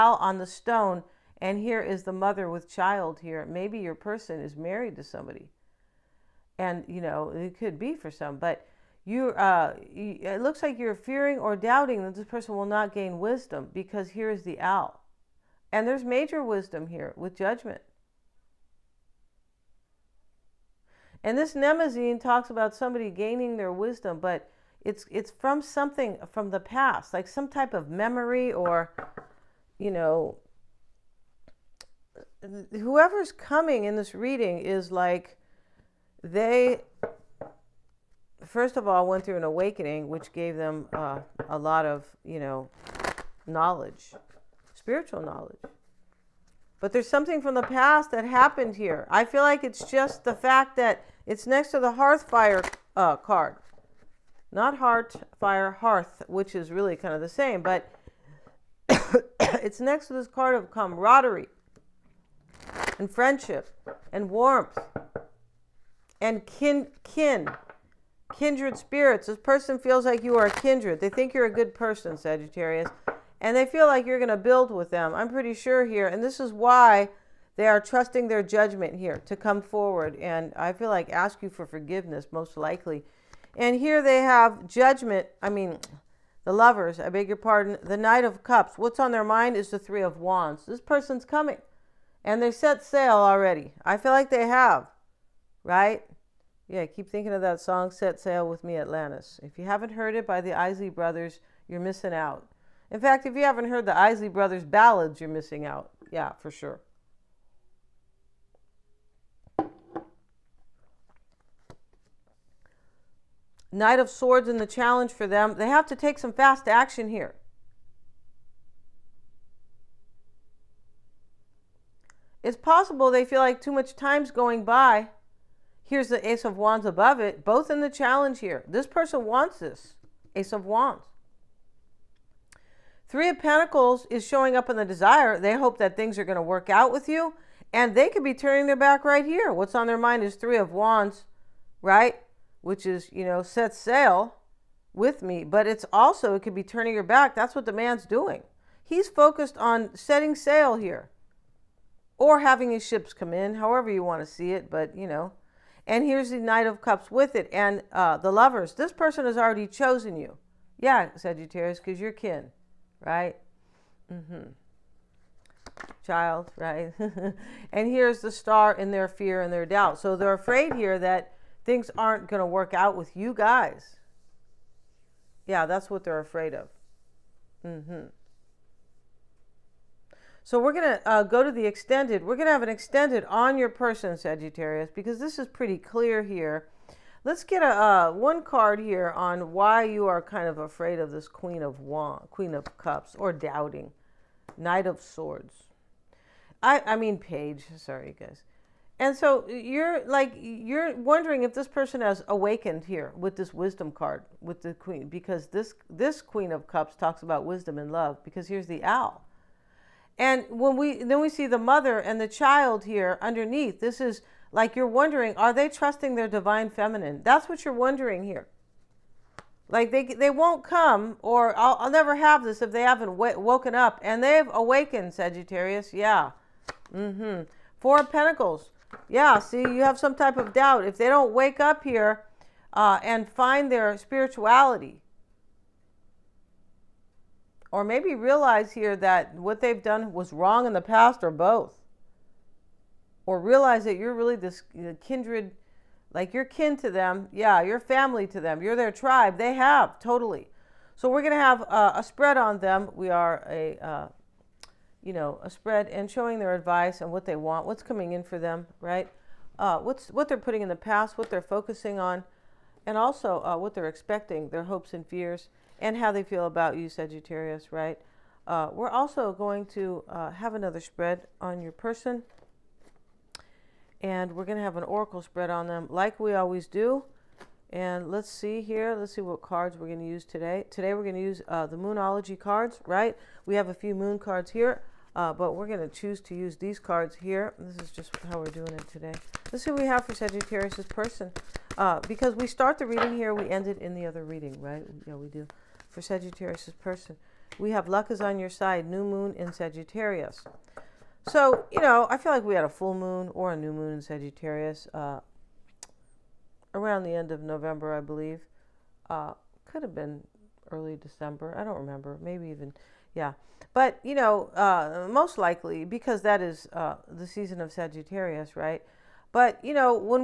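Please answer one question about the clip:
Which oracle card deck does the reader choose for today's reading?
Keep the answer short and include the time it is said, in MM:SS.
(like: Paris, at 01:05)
Moonology, at 04:41.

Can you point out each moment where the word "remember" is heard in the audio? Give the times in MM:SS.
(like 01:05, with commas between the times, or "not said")
05:11.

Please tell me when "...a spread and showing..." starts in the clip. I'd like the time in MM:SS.
04:15.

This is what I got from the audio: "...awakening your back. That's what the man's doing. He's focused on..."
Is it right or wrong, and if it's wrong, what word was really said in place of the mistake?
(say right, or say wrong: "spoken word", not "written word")
wrong: "turning", not "awakening".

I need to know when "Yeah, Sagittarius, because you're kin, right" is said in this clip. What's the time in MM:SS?
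02:40.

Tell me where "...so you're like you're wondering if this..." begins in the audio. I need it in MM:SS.
03:19.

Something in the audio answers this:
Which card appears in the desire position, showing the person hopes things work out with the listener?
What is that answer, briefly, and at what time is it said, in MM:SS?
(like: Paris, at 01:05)
Three of Pentacles, at 02:13.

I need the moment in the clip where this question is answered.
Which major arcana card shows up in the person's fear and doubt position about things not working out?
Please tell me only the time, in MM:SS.
02:48.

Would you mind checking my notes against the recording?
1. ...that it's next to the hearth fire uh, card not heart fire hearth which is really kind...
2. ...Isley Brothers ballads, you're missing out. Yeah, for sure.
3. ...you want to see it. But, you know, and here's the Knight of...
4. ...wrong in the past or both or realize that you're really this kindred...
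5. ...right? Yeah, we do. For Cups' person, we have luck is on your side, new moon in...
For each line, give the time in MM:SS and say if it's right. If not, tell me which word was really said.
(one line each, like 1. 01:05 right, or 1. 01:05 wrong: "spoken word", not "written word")
1. 00:50 right
2. 01:43 right
3. 02:33 right
4. 04:00 right
5. 04:54 wrong: "Sagittarius", not "Cups".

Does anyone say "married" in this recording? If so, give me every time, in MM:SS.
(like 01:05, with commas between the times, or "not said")
00:04.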